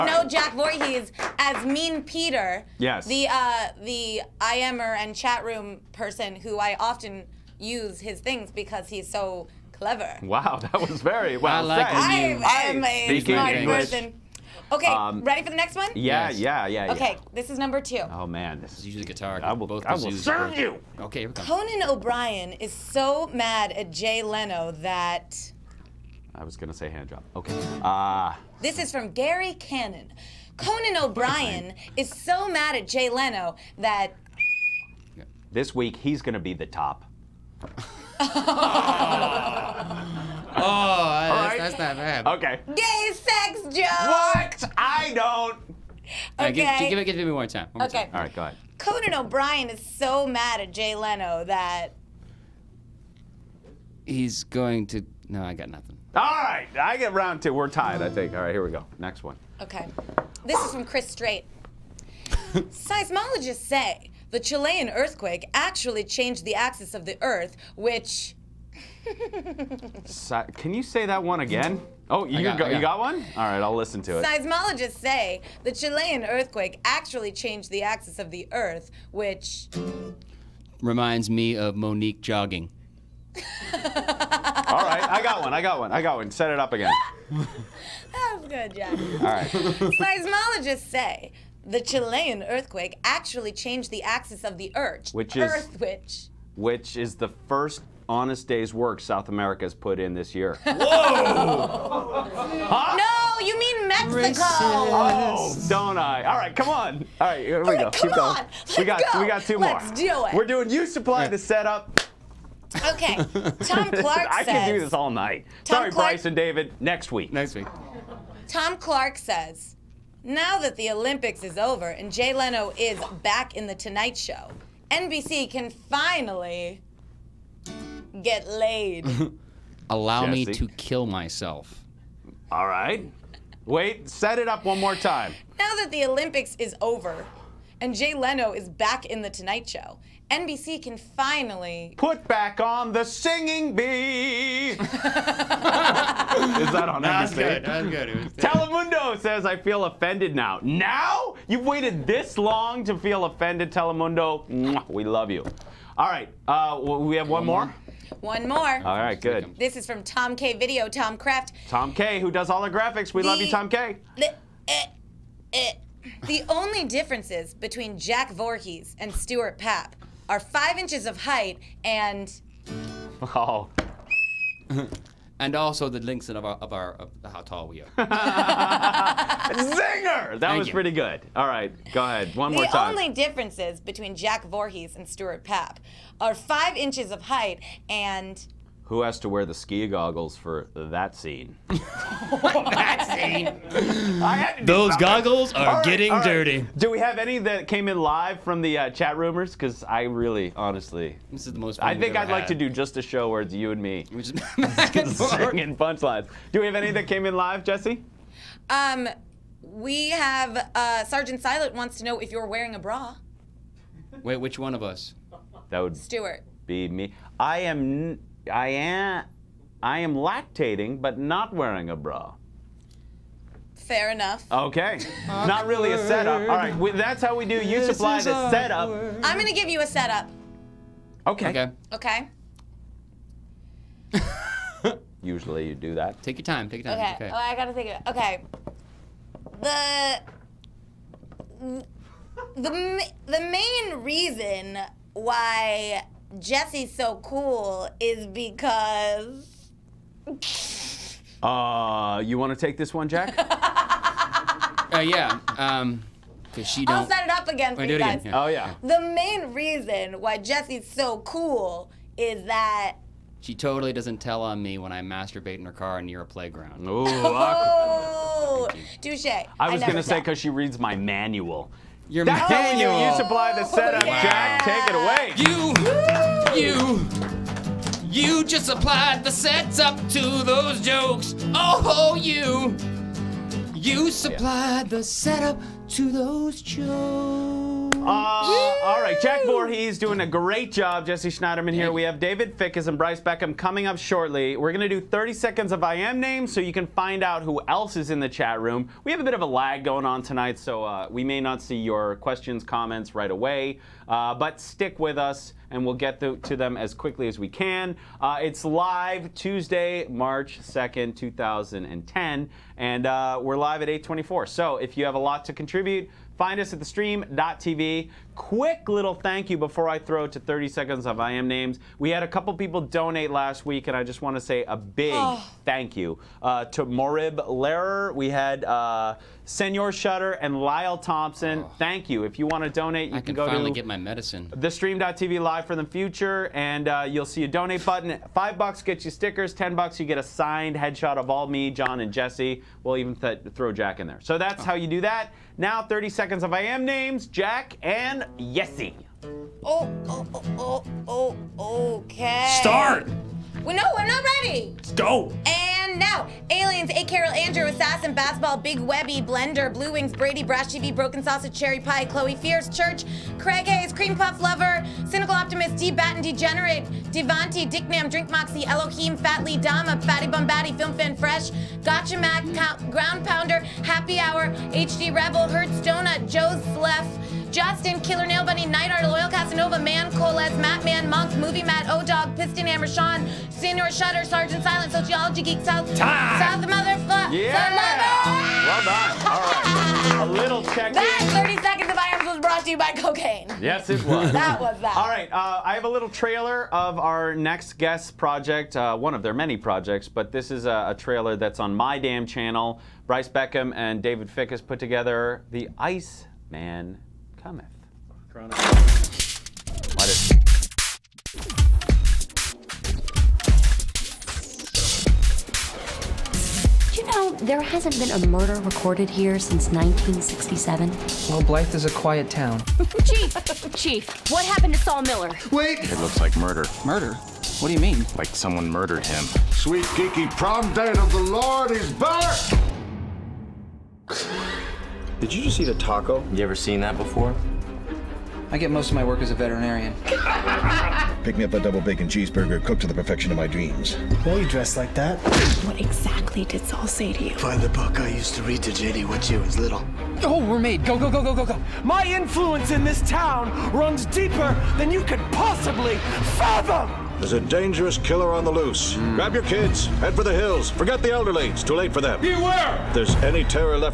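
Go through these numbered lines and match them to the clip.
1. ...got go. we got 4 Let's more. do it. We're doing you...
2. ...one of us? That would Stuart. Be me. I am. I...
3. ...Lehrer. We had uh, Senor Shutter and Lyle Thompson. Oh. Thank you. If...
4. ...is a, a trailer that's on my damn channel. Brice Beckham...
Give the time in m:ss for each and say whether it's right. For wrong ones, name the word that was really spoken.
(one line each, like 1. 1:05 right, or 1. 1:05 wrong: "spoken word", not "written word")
1. 1:48 wrong: "2", not "4"
2. 3:34 right
3. 5:27 right
4. 6:40 right.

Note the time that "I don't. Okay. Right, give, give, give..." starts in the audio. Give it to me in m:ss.
0:44.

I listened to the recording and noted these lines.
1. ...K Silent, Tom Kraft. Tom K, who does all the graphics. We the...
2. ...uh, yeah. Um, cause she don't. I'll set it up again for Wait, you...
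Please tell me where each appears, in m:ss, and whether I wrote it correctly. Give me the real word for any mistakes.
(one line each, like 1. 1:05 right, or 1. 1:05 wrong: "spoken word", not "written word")
1. 2:40 wrong: "Video", not "Silent"
2. 4:13 right.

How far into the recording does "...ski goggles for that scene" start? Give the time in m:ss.
3:09.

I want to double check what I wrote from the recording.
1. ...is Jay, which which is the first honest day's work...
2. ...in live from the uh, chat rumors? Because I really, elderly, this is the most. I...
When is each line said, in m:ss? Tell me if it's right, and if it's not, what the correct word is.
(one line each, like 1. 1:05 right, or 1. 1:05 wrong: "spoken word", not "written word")
1. 1:35 wrong: "Earth", not "Jay"
2. 3:17 wrong: "honestly", not "elderly".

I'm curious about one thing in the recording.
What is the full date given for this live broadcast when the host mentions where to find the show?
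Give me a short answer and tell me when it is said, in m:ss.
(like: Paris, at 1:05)
Tuesday, March 2nd, 2010, at 5:09.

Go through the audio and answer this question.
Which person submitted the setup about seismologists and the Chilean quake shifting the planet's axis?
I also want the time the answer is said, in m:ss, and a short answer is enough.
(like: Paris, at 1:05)
Chris Strait, at 1:00.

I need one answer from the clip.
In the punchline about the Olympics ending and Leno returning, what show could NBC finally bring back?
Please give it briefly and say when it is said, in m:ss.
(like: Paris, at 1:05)
The Singing Bee, at 2:22.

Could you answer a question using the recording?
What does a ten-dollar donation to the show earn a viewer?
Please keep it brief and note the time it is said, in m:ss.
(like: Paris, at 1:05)
A signed headshot, at 5:40.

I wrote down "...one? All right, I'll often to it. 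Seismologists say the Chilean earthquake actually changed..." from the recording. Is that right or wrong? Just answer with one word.
wrong.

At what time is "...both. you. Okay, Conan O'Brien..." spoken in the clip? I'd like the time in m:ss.
0:20.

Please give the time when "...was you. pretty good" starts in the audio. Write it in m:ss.
3:00.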